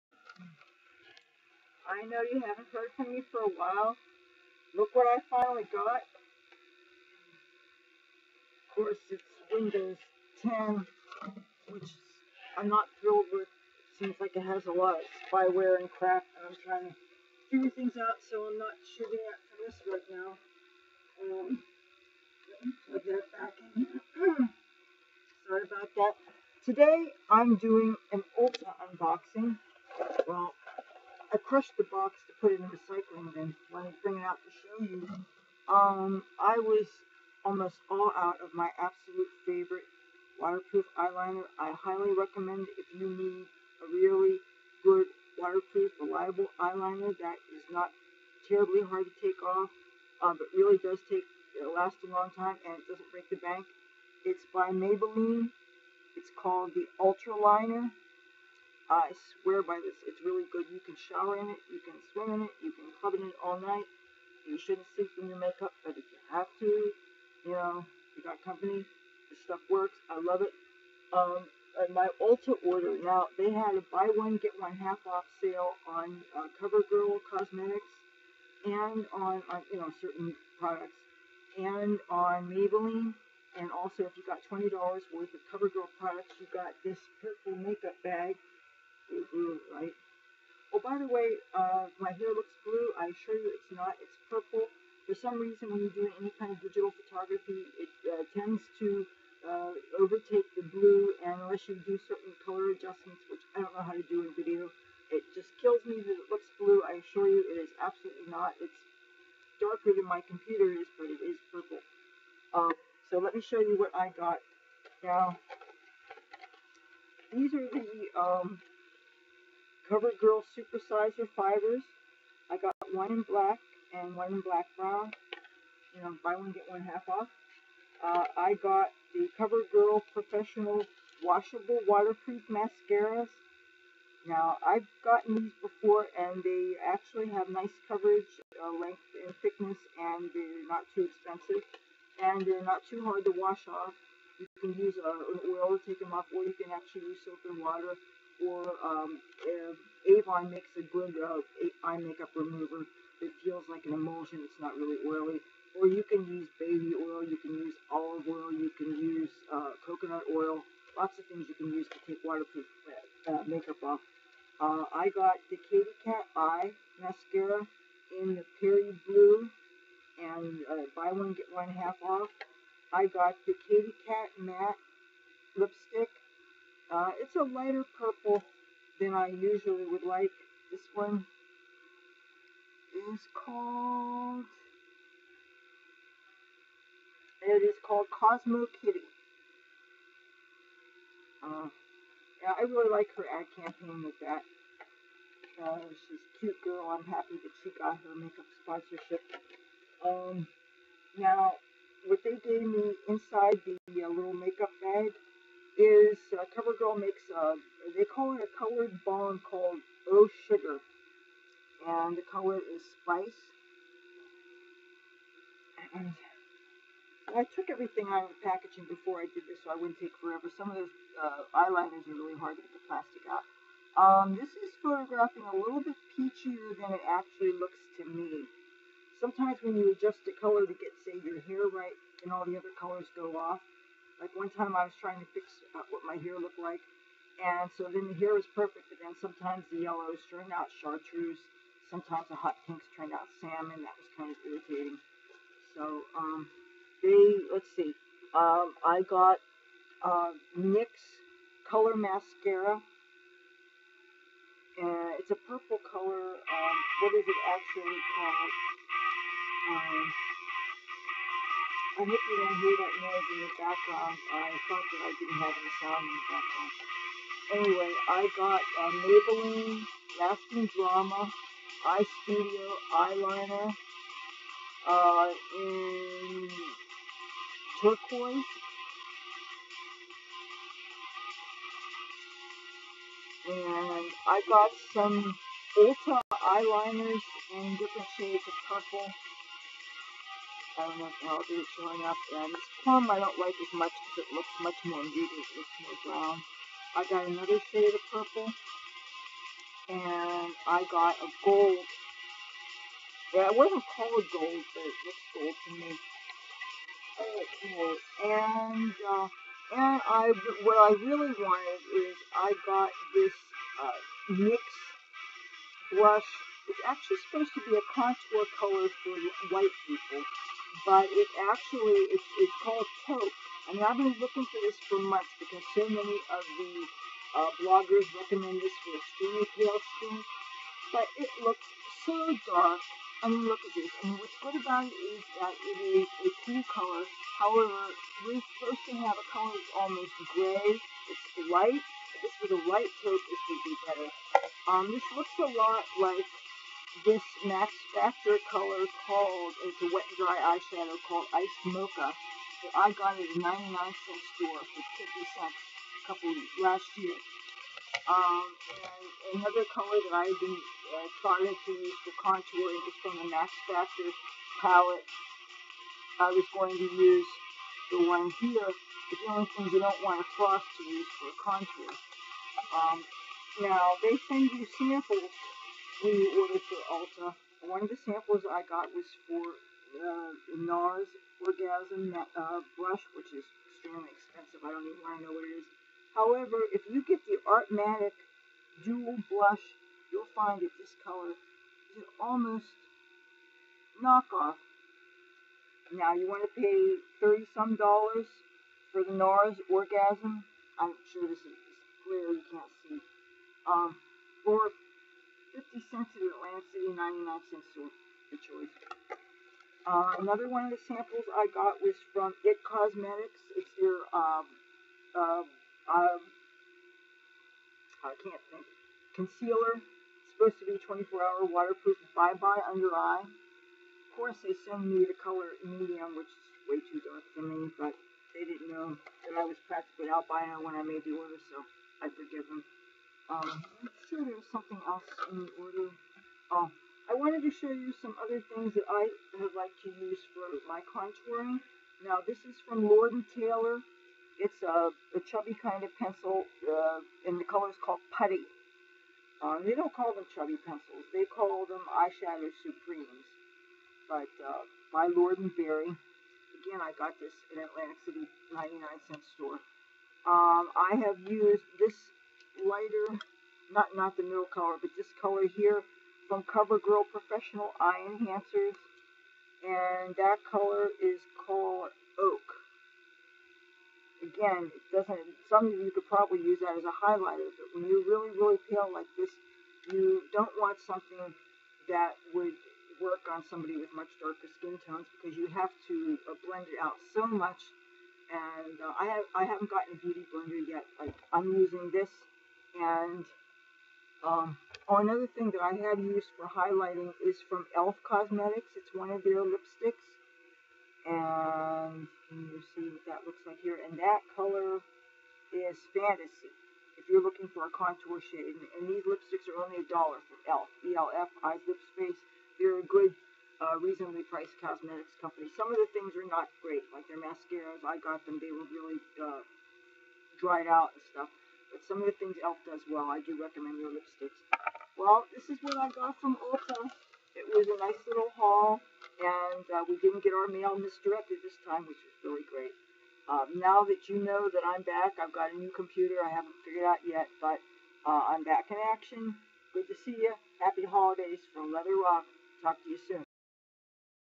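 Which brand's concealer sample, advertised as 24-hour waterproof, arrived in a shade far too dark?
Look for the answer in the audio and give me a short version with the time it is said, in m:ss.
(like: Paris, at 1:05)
It Cosmetics, at 6:52.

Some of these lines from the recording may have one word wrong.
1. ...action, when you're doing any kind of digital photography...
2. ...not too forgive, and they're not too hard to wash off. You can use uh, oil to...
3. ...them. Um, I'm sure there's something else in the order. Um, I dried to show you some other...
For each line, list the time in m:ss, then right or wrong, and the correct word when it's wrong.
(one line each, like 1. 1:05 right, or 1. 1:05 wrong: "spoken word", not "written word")
1. 1:35 wrong: "reason", not "action"
2. 2:20 wrong: "expensive", not "forgive"
3. 7:12 wrong: "wanted", not "dried".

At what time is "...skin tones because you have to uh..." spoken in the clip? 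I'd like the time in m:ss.
8:04.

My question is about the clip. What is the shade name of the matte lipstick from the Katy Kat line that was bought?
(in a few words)
Cosmo Kitty.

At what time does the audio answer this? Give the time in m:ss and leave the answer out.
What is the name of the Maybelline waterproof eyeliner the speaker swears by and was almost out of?
0:56.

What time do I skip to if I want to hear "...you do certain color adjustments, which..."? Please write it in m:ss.
1:41.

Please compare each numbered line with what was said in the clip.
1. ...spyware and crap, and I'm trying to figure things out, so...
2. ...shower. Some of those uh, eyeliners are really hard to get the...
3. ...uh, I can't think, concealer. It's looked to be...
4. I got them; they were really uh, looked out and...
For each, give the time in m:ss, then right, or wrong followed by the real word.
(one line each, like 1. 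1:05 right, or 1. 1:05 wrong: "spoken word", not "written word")
1. 0:15 right
2. 3:40 wrong: "forever", not "shower"
3. 6:55 wrong: "supposed", not "looked"
4. 8:37 wrong: "dried", not "looked".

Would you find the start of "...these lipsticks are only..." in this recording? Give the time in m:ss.
8:28.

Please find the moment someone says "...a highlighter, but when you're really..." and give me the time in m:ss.
7:56.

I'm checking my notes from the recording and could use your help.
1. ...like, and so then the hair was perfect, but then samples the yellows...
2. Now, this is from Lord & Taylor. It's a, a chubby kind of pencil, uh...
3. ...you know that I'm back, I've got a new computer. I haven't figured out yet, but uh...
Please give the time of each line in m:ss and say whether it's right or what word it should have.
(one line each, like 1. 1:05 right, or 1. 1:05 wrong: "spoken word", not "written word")
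1. 3:56 wrong: "sometimes", not "samples"
2. 7:22 right
3. 8:54 right.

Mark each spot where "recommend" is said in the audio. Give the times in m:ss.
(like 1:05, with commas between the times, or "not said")
0:42, 5:28, 8:43.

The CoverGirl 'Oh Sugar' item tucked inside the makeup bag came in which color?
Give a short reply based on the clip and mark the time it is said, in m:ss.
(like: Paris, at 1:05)
spice, at 3:33.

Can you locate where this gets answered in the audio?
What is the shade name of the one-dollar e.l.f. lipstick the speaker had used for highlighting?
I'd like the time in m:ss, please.
8:25.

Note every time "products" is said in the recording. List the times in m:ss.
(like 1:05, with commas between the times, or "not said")
1:20, 1:25.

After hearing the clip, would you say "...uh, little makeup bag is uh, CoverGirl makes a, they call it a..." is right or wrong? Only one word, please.
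right.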